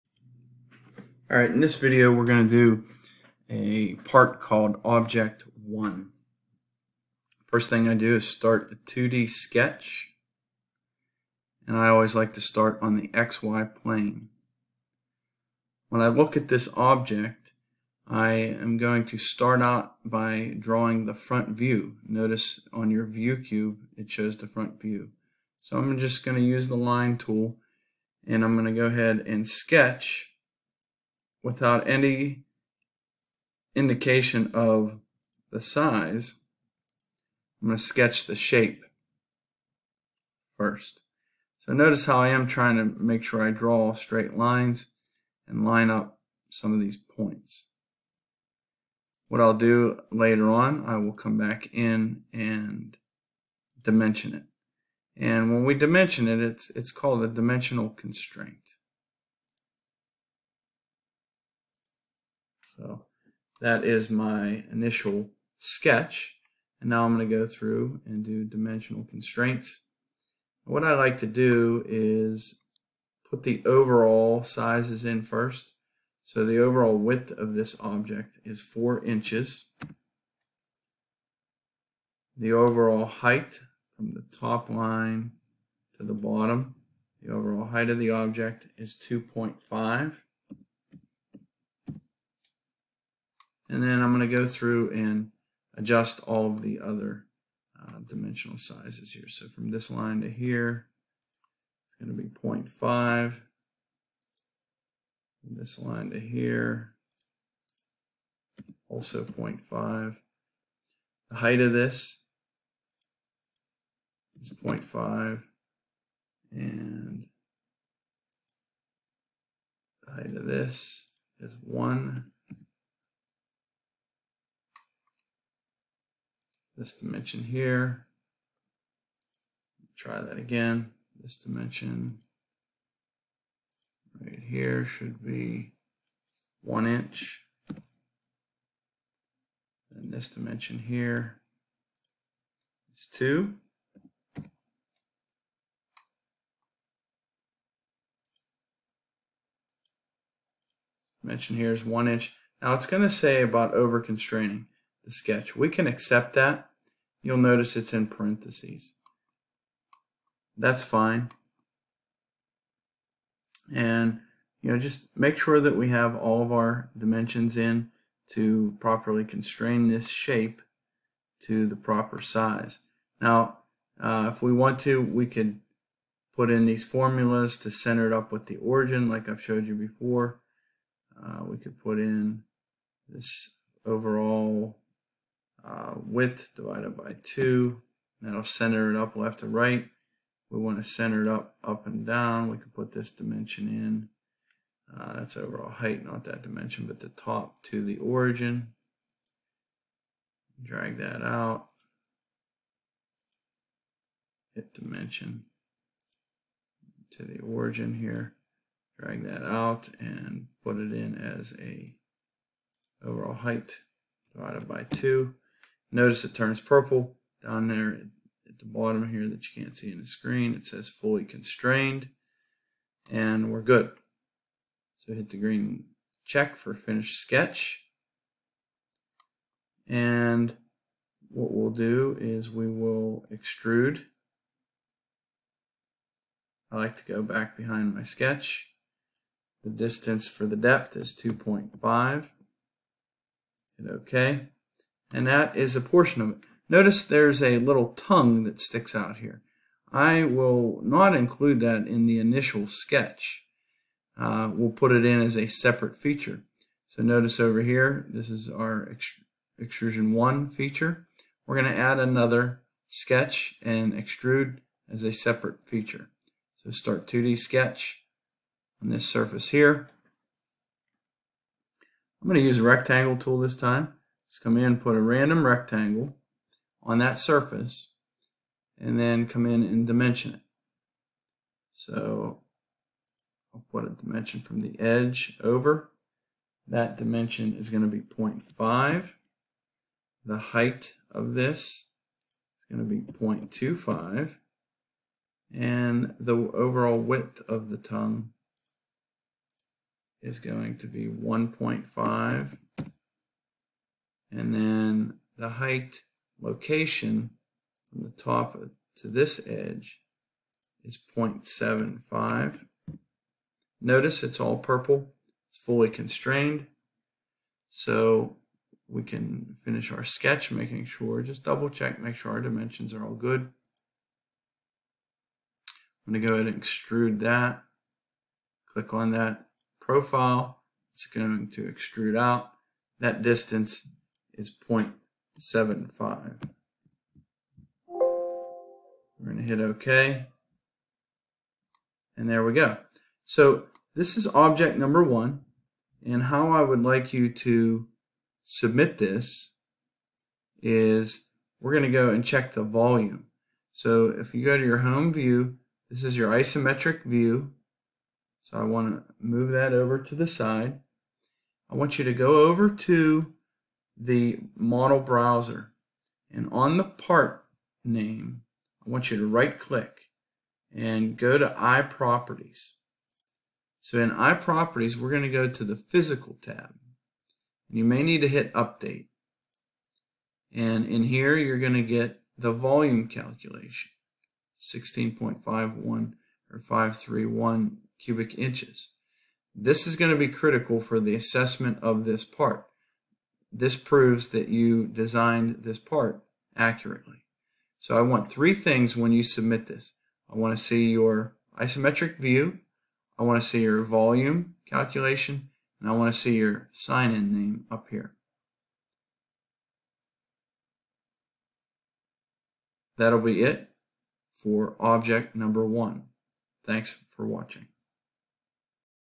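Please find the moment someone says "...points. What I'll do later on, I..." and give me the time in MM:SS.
00:46.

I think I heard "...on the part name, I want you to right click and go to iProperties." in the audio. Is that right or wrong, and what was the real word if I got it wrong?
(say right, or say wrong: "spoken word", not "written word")
right.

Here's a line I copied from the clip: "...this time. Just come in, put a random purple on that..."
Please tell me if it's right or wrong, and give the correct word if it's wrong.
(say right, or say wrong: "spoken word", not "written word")
wrong: "rectangle", not "purple".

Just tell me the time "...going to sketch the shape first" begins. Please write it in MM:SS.
00:37.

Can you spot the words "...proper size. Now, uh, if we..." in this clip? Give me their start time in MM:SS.
02:51.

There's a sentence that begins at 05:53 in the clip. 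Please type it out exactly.
So if you go to your home view, this is your isometric view.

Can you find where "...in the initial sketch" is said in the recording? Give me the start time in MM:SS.
04:11.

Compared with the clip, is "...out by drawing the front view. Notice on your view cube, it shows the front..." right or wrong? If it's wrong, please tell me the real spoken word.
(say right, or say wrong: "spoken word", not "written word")
right.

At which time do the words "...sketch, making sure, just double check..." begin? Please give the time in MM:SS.
05:20.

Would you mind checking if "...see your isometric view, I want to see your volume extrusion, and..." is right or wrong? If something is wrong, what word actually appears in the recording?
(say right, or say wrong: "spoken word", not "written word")
wrong: "calculation", not "extrusion".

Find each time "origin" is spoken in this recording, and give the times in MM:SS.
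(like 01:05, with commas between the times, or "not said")
02:58, 03:17, 03:27.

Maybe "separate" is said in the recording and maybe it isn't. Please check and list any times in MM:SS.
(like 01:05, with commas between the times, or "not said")
04:15, 04:25.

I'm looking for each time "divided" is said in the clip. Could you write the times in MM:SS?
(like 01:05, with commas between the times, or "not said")
03:06, 03:34.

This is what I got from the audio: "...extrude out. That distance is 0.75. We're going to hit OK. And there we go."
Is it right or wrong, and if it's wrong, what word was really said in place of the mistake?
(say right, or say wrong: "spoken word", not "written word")
right.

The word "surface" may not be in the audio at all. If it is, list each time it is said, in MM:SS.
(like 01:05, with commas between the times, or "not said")
04:29, 04:37.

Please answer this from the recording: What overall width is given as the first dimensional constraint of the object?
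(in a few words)
4 inches.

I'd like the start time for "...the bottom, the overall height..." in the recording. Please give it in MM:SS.
01:26.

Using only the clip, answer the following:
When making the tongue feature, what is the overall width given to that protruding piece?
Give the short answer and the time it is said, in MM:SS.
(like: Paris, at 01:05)
1.5, at 05:01.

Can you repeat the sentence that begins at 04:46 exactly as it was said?
That dimension is going to be 0.5.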